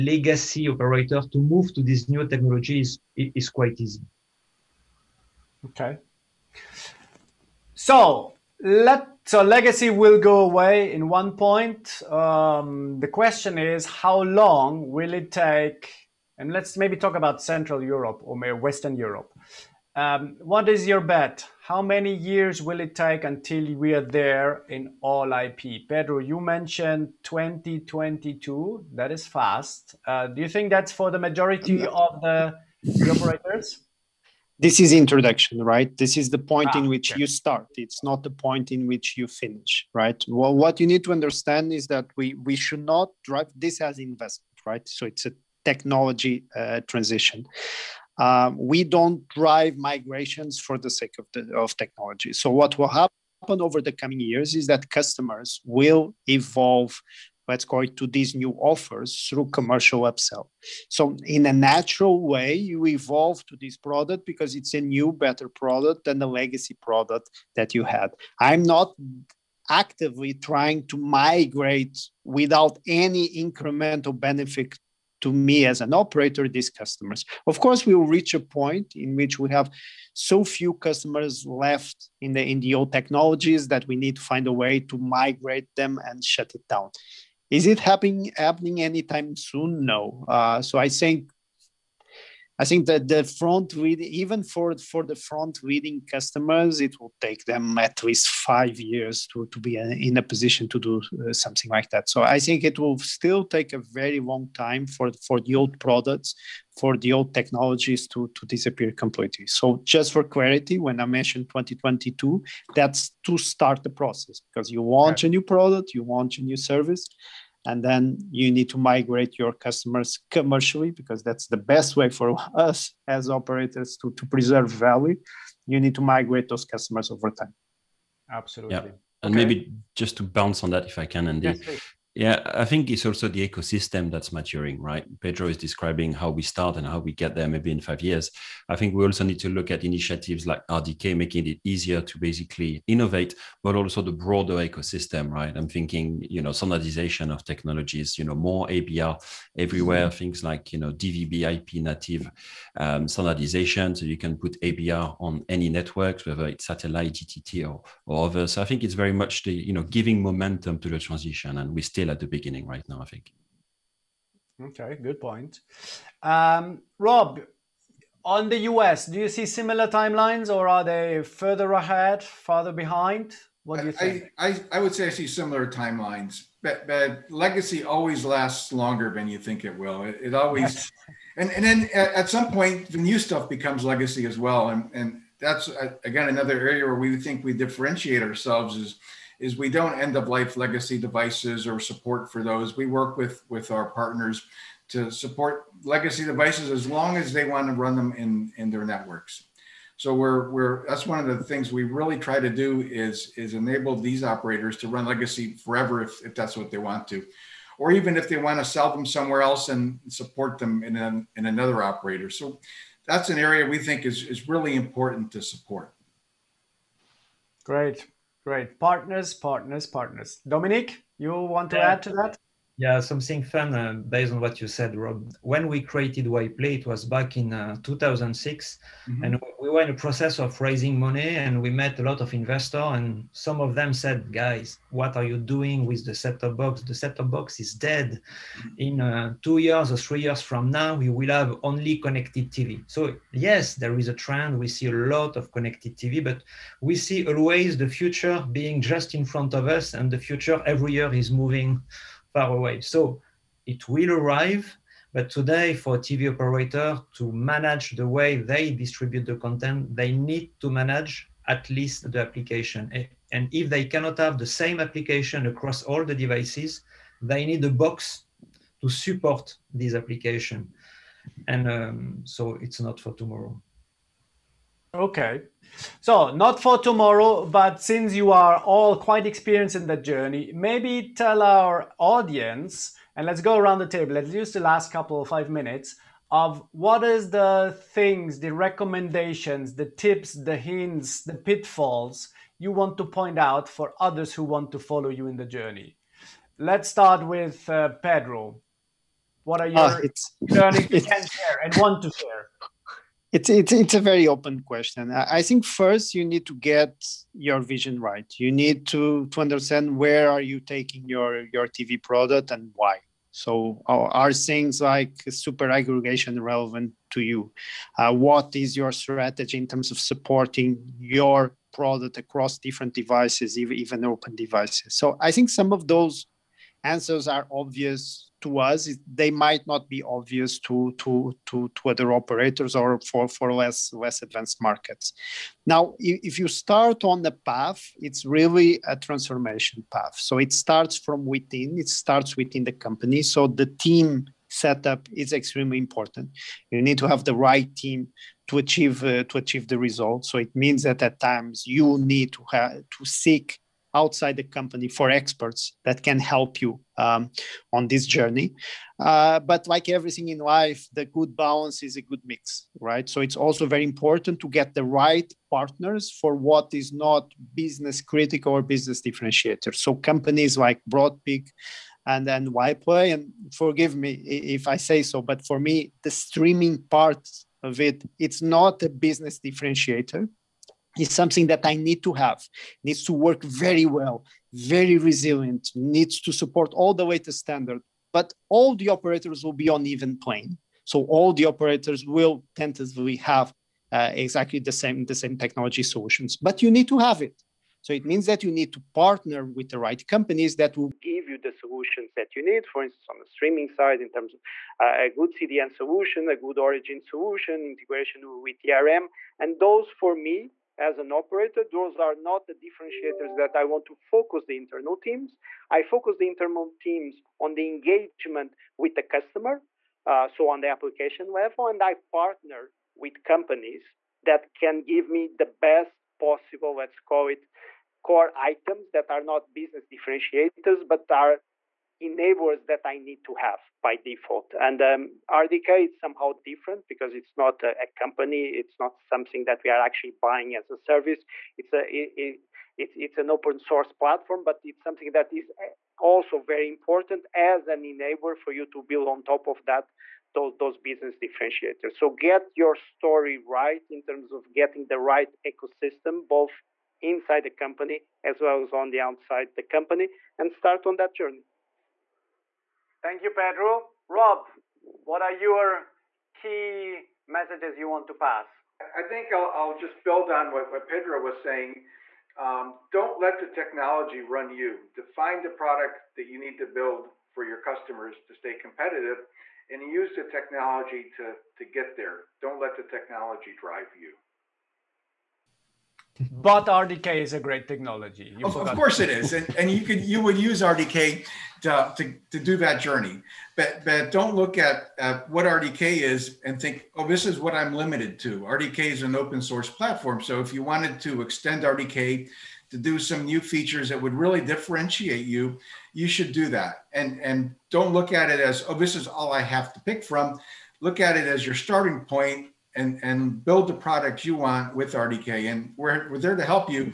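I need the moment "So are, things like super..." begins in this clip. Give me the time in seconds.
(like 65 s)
313 s.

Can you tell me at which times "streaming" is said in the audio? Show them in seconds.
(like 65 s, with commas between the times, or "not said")
376 s, 403 s.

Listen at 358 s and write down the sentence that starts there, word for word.
Uh, but like everything in life, the good balance is a good mix, right?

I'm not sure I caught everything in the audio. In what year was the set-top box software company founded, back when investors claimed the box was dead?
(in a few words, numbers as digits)
2006.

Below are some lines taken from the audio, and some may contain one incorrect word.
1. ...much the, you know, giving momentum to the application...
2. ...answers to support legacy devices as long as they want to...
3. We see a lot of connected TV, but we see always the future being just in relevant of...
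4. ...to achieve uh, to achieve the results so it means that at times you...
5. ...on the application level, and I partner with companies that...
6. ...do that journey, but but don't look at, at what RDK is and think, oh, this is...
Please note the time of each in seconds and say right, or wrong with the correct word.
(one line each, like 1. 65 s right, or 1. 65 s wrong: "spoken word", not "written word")
1. 159 s wrong: "transition", not "application"
2. 193 s wrong: "partners", not "answers"
3. 244 s wrong: "front", not "relevant"
4. 348 s right
5. 420 s right
6. 492 s right.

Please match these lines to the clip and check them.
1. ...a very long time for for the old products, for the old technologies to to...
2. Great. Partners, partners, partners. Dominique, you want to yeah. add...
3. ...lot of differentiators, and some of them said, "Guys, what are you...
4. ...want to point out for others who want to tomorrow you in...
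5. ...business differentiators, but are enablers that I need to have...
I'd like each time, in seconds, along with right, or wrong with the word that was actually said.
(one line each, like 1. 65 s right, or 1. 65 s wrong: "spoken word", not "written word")
1. 103 s right
2. 218 s right
3. 232 s wrong: "investors", not "differentiators"
4. 292 s wrong: "follow", not "tomorrow"
5. 429 s right.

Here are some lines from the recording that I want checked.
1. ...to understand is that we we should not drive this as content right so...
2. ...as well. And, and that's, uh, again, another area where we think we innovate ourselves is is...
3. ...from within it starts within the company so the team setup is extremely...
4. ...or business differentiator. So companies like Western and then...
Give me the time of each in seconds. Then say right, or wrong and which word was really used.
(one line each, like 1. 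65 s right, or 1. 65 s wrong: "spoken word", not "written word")
1. 41 s wrong: "investment", not "content"
2. 184 s wrong: "differentiate", not "innovate"
3. 341 s right
4. 368 s wrong: "Broadpeak", not "Western".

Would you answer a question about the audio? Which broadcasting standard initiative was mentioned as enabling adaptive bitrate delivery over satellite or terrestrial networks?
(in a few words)
DVB IP.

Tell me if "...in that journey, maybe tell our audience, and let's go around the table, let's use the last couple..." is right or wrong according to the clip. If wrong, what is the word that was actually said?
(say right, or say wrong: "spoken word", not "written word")
right.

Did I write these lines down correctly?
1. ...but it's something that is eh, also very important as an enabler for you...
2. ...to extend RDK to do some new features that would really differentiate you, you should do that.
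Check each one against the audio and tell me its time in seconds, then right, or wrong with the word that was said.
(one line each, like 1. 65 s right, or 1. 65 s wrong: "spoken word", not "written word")
1. 444 s right
2. 501 s right.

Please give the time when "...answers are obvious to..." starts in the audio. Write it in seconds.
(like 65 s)
326 s.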